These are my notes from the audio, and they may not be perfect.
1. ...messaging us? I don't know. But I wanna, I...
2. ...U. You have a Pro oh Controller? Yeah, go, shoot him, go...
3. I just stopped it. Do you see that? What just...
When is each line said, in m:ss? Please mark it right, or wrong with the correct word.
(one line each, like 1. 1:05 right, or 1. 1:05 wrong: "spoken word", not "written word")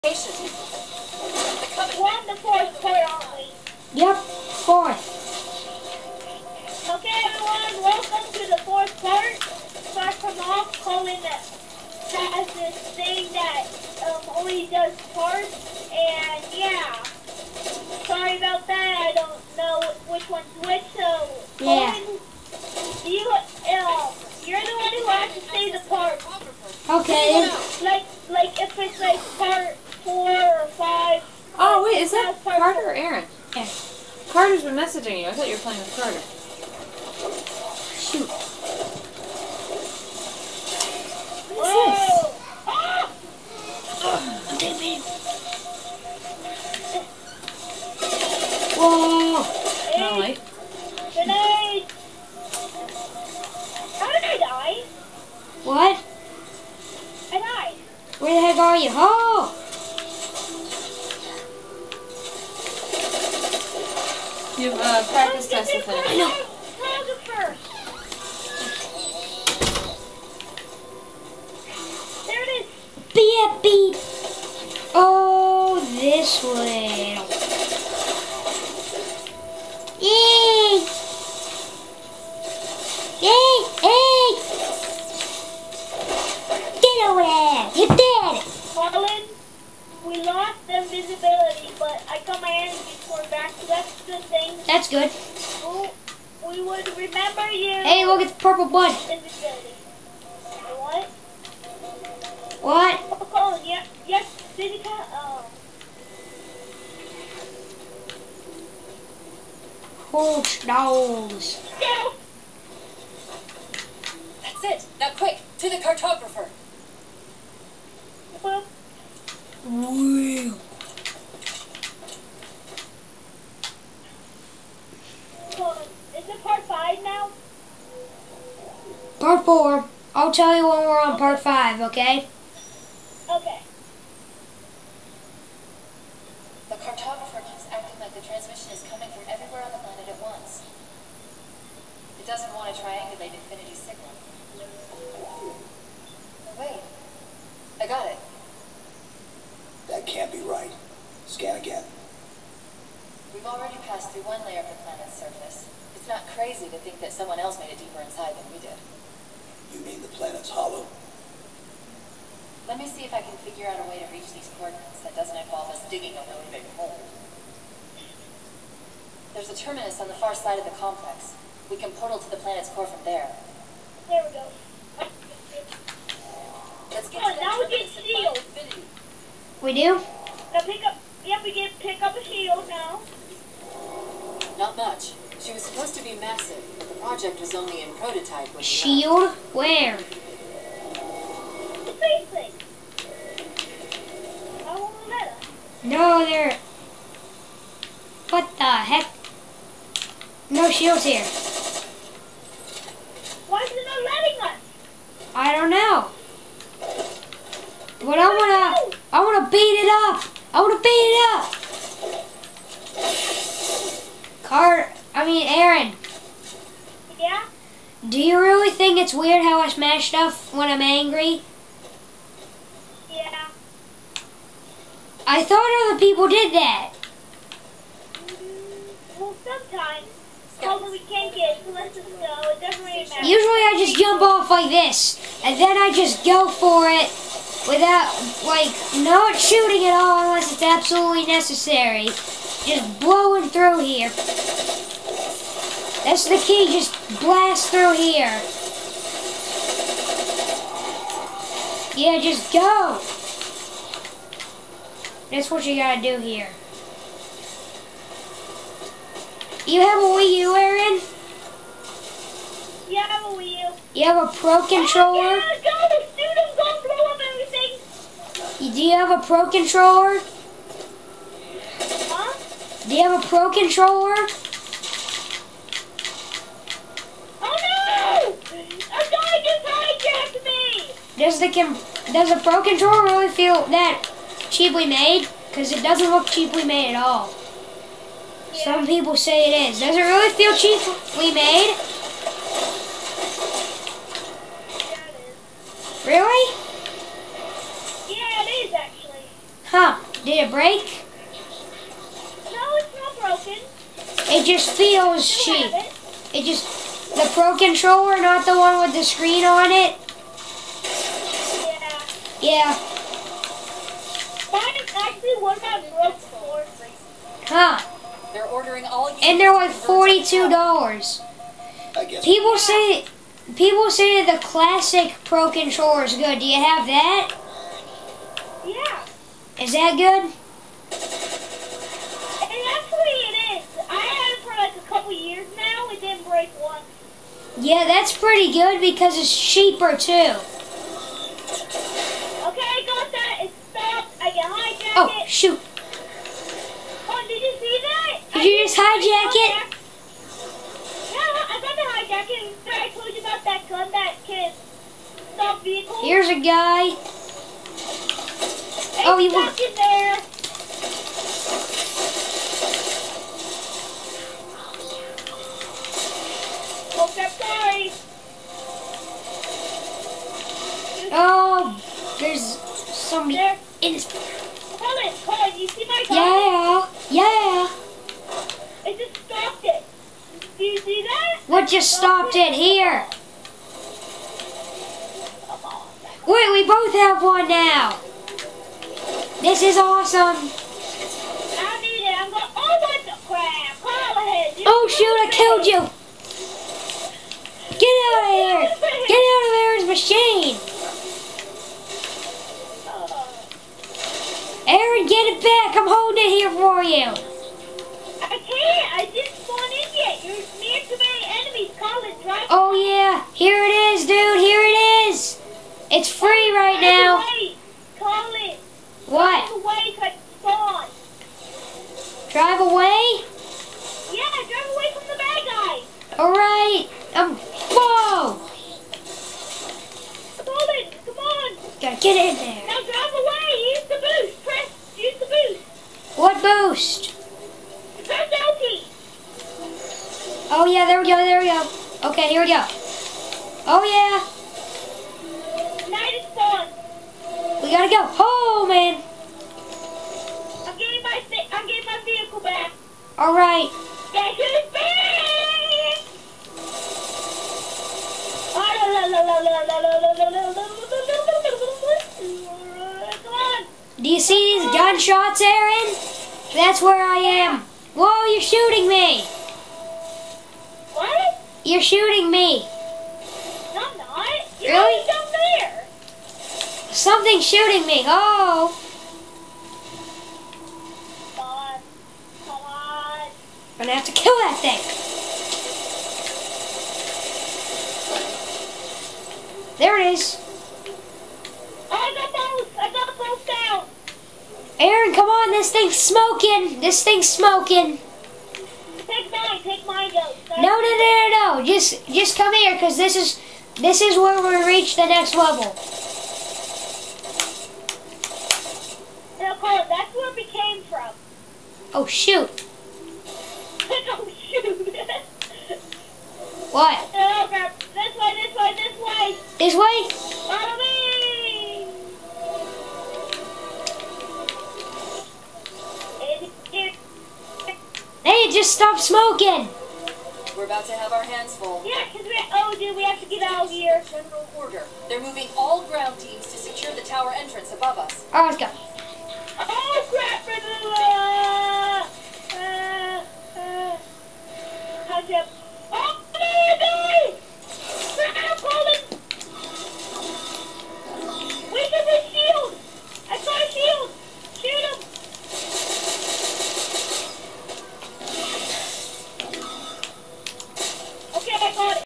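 1. 3:24 wrong: "letting", not "messaging"
2. 4:23 right
3. 6:18 right.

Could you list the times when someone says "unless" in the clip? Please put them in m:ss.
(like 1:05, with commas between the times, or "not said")
4:00.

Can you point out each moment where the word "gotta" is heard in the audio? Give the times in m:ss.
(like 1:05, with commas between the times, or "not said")
4:15, 7:11, 7:27.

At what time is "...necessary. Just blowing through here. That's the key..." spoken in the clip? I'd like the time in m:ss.
4:01.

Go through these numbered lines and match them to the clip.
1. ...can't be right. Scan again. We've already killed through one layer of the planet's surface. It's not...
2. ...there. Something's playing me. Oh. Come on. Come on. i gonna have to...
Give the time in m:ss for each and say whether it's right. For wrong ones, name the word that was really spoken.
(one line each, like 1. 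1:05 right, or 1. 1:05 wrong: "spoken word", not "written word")
1. 2:30 wrong: "passed", not "killed"
2. 7:55 wrong: "shooting", not "playing".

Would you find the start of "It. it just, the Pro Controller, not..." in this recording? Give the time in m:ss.
5:05.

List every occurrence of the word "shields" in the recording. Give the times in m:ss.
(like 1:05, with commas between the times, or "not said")
2:57, 3:02, 3:08, 3:20.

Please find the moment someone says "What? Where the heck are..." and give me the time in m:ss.
0:55.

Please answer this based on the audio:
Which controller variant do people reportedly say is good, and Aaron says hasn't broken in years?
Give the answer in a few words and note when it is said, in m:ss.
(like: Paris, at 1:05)
Classic Pro controller, at 5:24.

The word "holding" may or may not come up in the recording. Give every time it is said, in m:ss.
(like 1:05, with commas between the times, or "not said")
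6:45.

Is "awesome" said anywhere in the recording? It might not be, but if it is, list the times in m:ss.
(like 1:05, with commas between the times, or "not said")
6:29.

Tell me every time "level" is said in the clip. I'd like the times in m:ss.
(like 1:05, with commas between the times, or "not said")
8:25.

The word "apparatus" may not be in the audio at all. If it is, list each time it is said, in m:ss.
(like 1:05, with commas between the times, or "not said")
not said.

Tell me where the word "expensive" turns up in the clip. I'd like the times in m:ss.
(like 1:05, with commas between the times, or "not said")
not said.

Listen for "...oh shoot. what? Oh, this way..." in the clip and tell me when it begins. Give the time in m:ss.
8:33.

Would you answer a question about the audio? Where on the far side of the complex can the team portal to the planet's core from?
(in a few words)
A terminus.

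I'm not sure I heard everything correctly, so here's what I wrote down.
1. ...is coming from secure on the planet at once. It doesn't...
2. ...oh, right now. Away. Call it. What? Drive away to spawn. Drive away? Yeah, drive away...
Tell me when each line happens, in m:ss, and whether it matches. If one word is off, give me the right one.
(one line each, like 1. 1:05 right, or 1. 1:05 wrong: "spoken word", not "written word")
1. 2:18 wrong: "everywhere", not "secure"
2. 6:56 right.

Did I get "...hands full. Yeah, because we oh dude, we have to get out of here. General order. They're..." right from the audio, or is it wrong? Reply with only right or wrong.
right.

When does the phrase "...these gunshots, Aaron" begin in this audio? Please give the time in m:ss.
7:44.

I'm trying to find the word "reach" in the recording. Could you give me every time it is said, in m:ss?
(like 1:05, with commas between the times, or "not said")
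2:44, 8:24.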